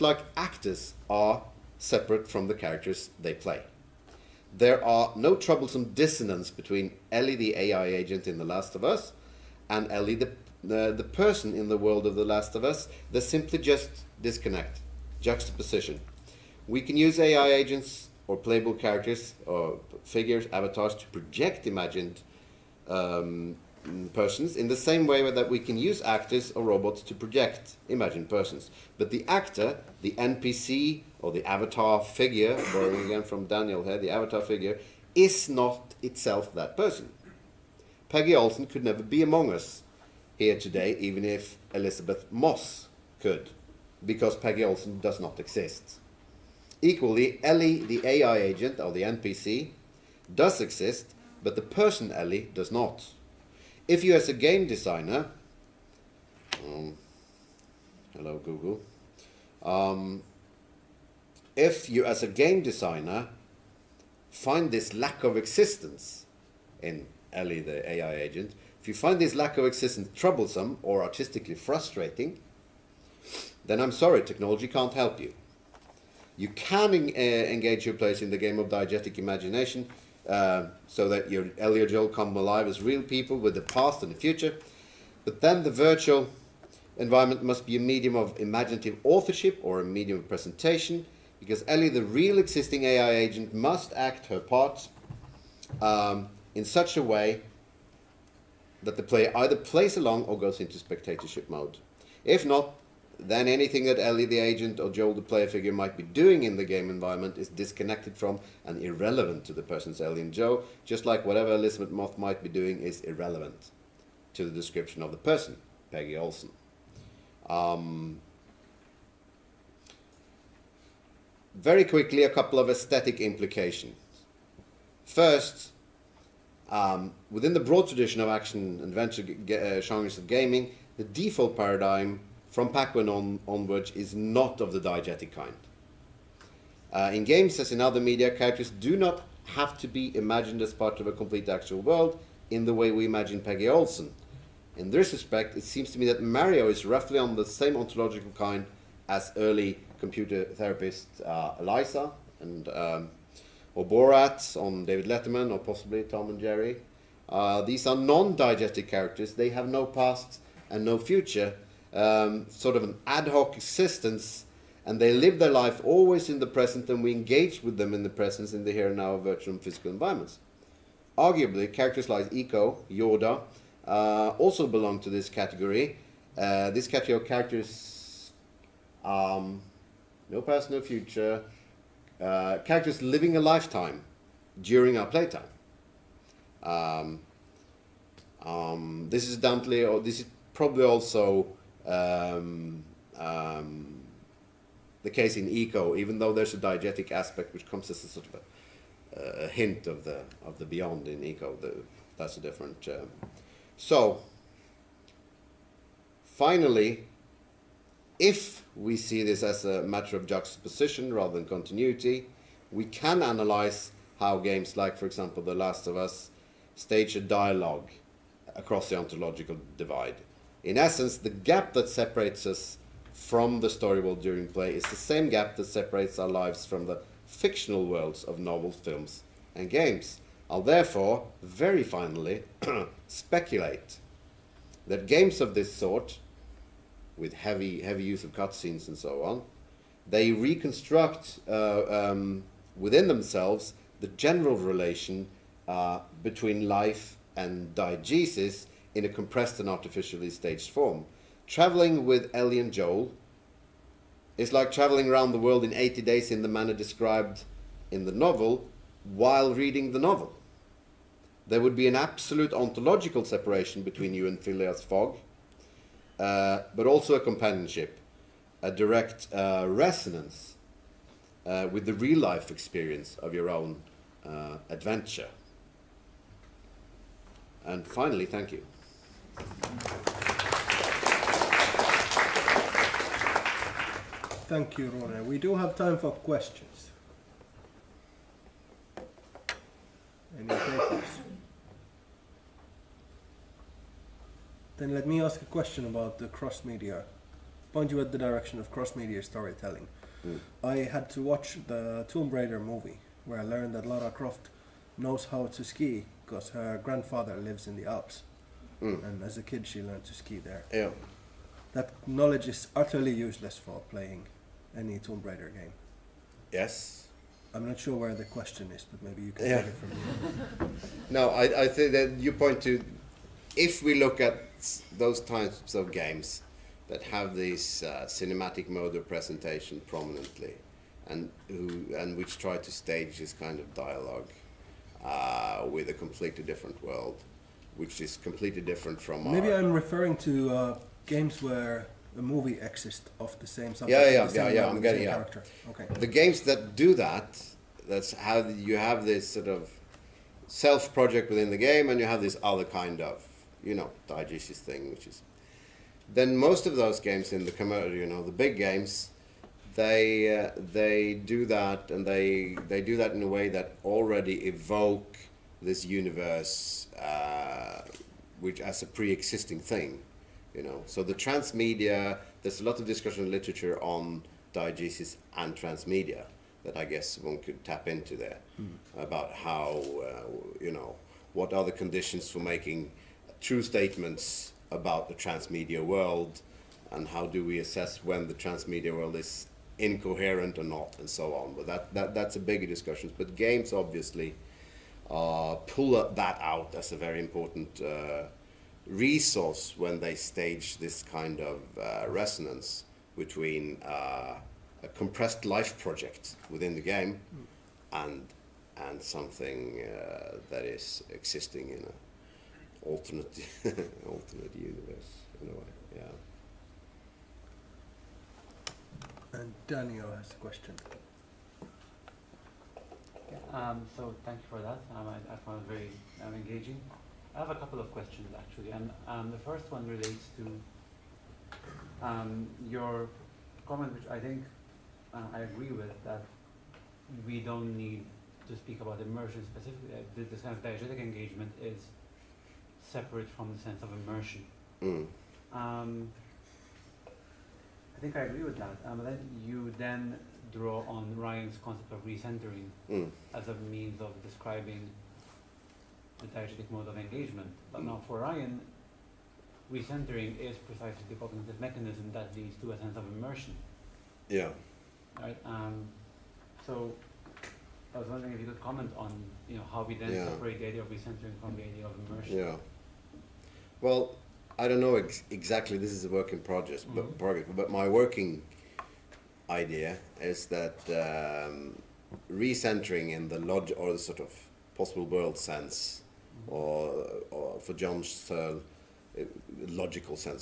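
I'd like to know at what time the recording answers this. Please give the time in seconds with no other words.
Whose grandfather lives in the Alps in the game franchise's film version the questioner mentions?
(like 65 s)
303 s.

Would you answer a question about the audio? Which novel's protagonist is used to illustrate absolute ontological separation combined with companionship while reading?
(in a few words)
Phileas Fogg.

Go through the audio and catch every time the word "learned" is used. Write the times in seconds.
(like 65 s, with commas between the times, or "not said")
303 s, 309 s.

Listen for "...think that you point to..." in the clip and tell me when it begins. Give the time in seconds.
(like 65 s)
321 s.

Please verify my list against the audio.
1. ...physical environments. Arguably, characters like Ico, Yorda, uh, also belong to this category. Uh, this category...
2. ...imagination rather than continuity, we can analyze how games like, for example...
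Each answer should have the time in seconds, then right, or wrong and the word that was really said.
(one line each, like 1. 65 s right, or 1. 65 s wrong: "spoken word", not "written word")
1. 169 s right
2. 210 s wrong: "juxtaposition", not "imagination".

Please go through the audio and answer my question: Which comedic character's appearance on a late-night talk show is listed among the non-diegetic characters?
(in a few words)
Borat.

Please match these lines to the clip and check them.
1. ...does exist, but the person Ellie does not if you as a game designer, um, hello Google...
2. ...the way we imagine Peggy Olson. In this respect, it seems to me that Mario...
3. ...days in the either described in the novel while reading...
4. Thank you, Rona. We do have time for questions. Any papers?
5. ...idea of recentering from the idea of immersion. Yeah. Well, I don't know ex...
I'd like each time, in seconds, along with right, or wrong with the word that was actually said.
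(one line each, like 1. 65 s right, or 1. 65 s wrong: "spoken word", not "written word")
1. 50 s right
2. 142 s right
3. 256 s wrong: "manner", not "either"
4. 284 s right
5. 470 s right.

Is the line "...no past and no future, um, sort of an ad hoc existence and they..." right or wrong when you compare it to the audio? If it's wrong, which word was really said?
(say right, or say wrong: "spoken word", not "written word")
right.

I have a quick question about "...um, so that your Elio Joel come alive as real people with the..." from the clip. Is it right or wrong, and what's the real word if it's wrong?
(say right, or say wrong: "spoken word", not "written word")
right.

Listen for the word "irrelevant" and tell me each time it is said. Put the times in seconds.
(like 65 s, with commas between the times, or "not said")
108 s, 113 s.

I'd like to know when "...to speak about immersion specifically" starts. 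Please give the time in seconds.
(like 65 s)
438 s.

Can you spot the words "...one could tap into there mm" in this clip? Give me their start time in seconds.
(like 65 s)
377 s.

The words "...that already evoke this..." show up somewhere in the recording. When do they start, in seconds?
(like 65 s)
363 s.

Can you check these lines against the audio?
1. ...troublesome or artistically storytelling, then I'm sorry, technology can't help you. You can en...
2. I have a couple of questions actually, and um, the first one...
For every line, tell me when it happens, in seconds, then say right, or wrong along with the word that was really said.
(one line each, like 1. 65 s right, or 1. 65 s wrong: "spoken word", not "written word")
1. 70 s wrong: "frustrating", not "storytelling"
2. 427 s right.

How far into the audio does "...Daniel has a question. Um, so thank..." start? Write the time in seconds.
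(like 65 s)
419 s.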